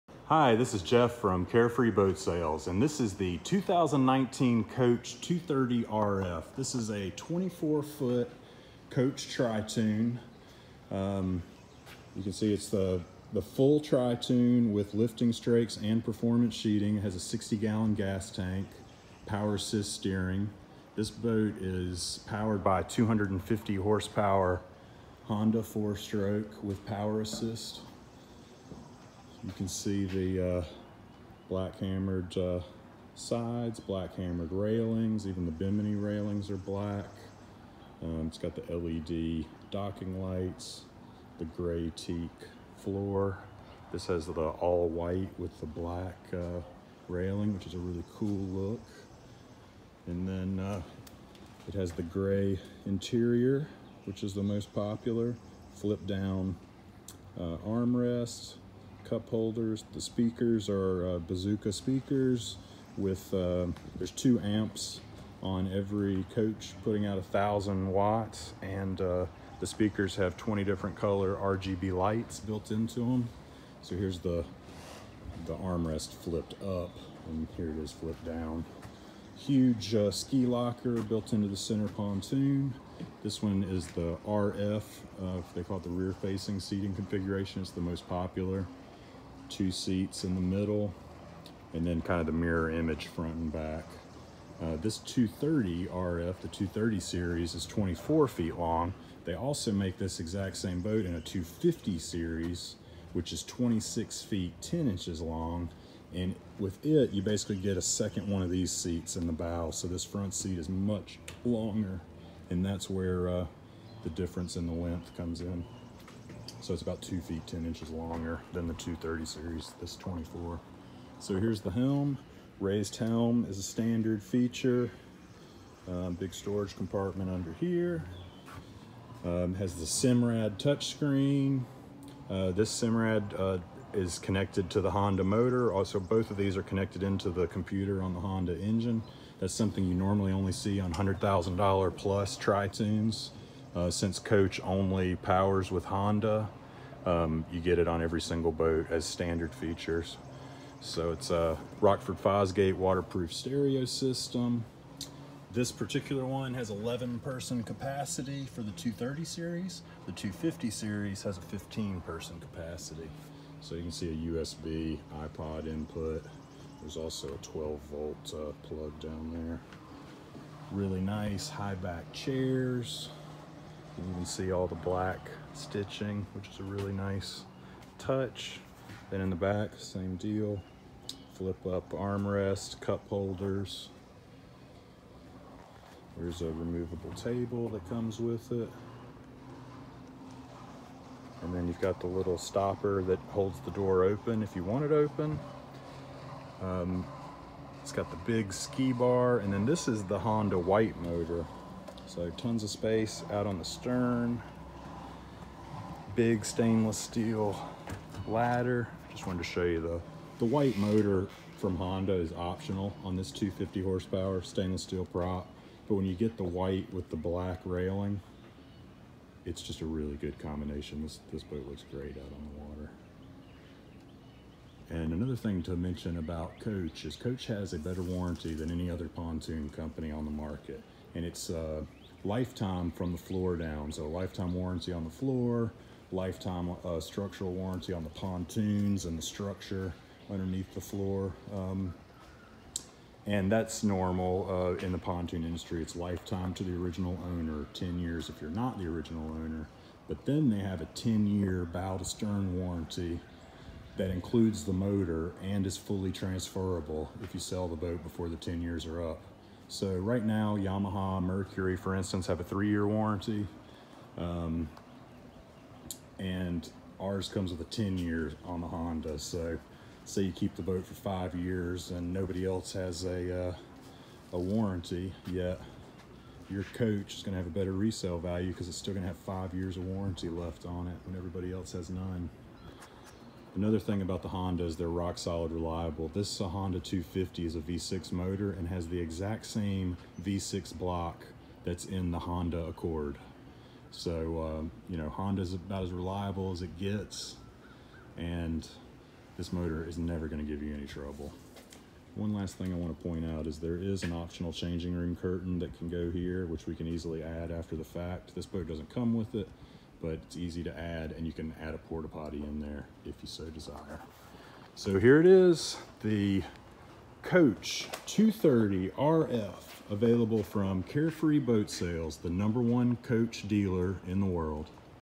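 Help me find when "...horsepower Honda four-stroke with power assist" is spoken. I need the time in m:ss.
0:23.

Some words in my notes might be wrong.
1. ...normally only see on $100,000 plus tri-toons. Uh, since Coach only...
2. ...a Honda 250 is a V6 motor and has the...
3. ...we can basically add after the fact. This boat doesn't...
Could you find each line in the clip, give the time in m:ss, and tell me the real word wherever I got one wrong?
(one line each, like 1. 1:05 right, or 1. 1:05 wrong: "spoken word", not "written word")
1. 2:19 right
2. 4:46 right
3. 5:06 wrong: "easily", not "basically".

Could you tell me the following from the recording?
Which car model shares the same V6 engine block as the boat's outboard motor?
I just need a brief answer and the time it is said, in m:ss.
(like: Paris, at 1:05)
Honda Accord, at 4:52.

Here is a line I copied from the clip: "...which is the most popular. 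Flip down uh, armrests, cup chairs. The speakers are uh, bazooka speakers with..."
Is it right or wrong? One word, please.
wrong.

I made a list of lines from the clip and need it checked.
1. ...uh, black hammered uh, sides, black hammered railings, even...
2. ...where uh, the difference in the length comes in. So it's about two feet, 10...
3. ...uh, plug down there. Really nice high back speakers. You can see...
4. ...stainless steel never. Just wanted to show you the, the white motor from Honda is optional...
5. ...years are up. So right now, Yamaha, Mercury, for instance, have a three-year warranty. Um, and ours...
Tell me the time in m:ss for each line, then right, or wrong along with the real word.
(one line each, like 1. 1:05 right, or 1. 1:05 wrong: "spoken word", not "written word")
1. 0:30 right
2. 1:52 right
3. 2:48 wrong: "chairs", not "speakers"
4. 3:26 wrong: "ladder", not "never"
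5. 4:18 right.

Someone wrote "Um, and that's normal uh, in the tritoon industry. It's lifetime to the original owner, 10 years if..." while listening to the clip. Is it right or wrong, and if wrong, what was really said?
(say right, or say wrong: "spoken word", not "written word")
wrong: "pontoon", not "tritoon".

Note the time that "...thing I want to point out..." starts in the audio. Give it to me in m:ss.
5:02.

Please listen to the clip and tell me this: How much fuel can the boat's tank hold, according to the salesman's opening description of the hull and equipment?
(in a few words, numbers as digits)
60 gallons.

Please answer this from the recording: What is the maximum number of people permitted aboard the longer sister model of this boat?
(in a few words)
15.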